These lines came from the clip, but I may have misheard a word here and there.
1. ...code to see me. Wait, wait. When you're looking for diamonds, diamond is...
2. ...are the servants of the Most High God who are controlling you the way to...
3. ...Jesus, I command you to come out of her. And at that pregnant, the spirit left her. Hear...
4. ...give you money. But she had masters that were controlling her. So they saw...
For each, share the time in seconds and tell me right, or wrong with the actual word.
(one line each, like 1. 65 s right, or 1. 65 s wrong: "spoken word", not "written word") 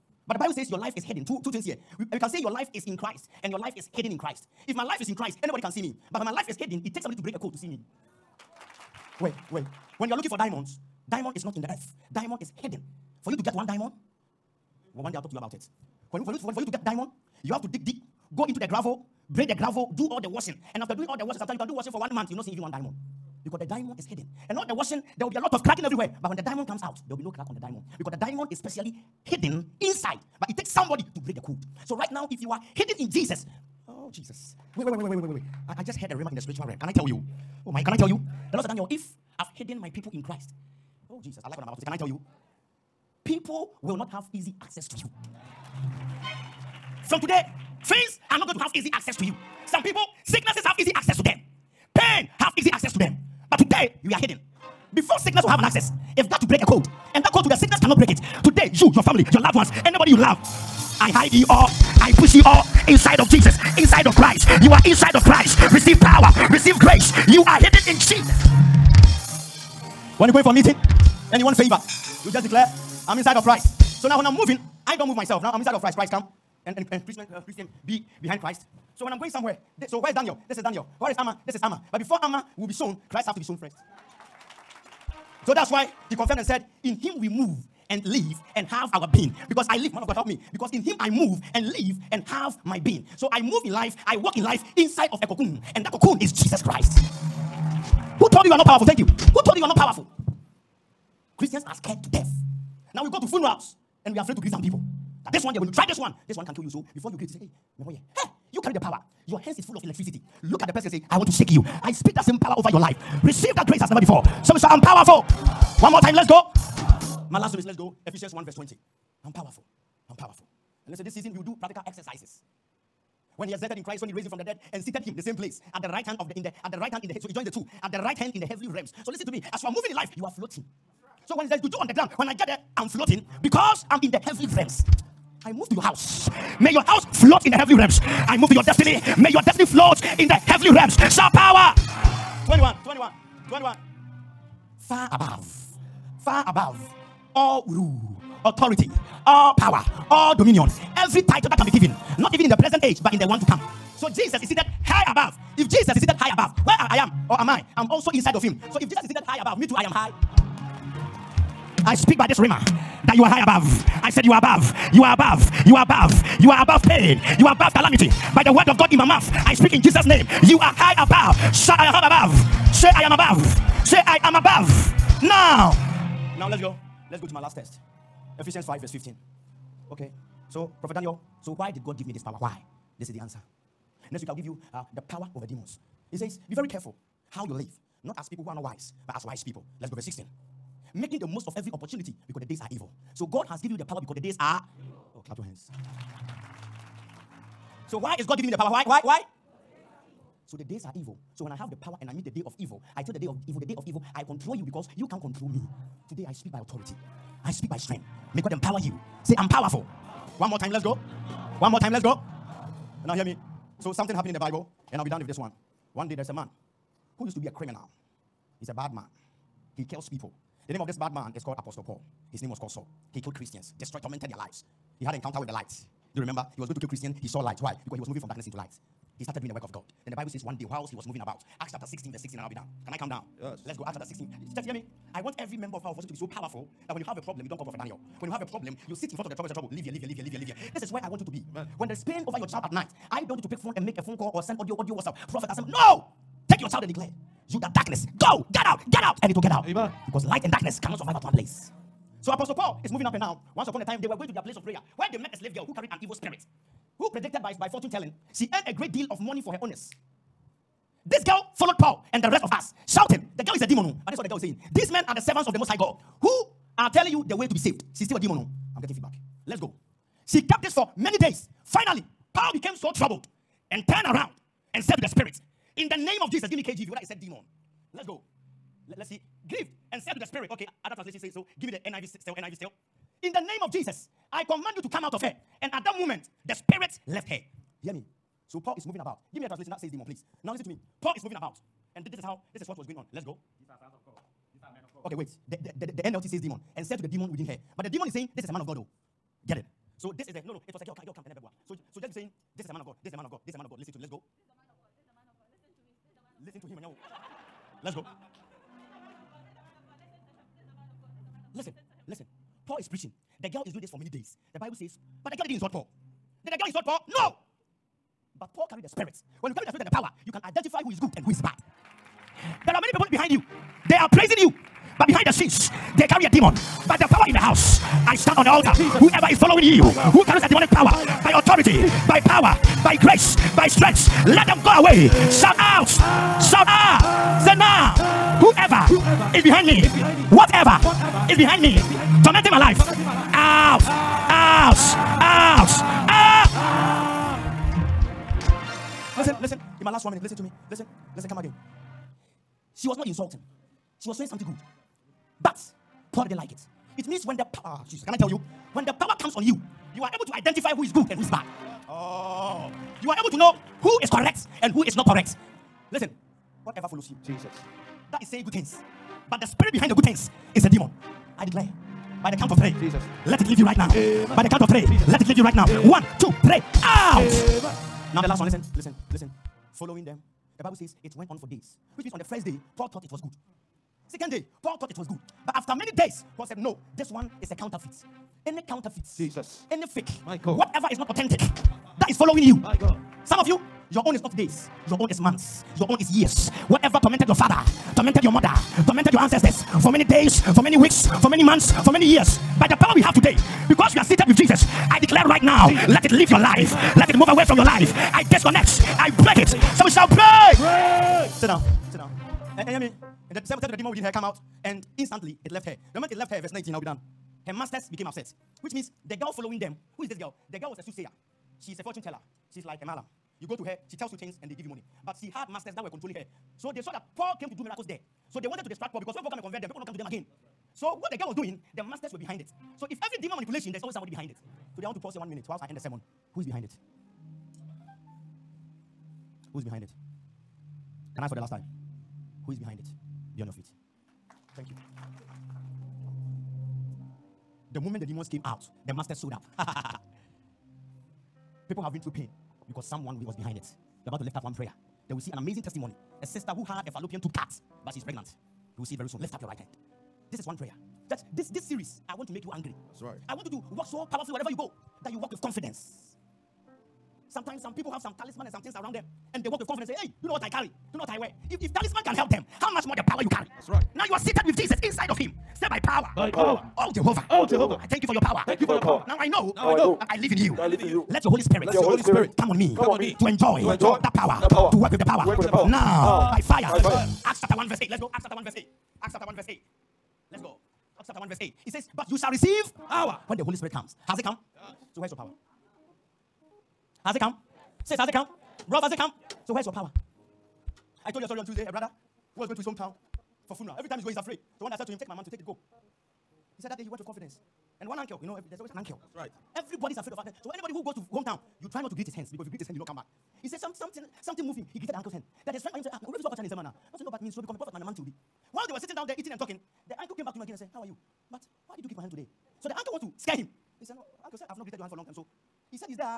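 1. 7 s right
2. 265 s wrong: "telling", not "controlling"
3. 283 s wrong: "moment", not "pregnant"
4. 424 s right.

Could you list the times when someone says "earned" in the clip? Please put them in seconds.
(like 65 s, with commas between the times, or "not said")
258 s.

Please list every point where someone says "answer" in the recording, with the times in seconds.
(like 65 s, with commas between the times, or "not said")
183 s.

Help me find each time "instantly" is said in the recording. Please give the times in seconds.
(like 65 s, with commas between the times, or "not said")
414 s.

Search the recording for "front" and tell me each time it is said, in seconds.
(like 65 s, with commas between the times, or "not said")
239 s.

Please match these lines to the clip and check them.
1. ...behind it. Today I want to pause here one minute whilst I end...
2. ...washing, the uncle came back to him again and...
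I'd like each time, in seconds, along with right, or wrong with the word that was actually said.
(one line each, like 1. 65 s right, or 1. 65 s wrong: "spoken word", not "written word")
1. 434 s right
2. 519 s wrong: "talking", not "washing".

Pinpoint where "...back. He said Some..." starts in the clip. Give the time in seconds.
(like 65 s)
512 s.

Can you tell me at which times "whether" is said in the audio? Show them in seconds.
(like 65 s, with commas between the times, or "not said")
276 s.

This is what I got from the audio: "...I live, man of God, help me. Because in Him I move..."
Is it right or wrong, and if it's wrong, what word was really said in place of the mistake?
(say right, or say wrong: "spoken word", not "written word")
right.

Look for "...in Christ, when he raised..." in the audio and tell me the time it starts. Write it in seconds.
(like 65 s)
123 s.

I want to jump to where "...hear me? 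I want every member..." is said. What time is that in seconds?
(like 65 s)
234 s.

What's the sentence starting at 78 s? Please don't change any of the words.
So when I'm going somewhere, so where is Daniel?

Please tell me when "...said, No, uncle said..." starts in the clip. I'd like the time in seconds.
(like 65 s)
523 s.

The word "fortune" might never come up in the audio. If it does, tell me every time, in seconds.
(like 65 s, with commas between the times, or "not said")
257 s, 421 s.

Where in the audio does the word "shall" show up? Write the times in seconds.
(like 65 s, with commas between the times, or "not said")
409 s, 492 s.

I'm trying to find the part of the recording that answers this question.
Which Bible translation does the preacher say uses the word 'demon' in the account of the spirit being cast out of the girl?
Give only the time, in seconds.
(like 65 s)
296 s.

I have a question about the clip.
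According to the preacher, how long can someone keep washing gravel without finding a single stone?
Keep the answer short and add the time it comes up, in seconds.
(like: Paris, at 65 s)
One month, at 21 s.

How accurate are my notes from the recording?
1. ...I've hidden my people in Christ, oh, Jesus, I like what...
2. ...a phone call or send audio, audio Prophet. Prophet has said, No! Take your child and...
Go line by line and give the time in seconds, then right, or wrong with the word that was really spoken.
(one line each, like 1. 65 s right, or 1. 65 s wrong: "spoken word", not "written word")
1. 39 s right
2. 243 s wrong: "WhatsApp", not "Prophet".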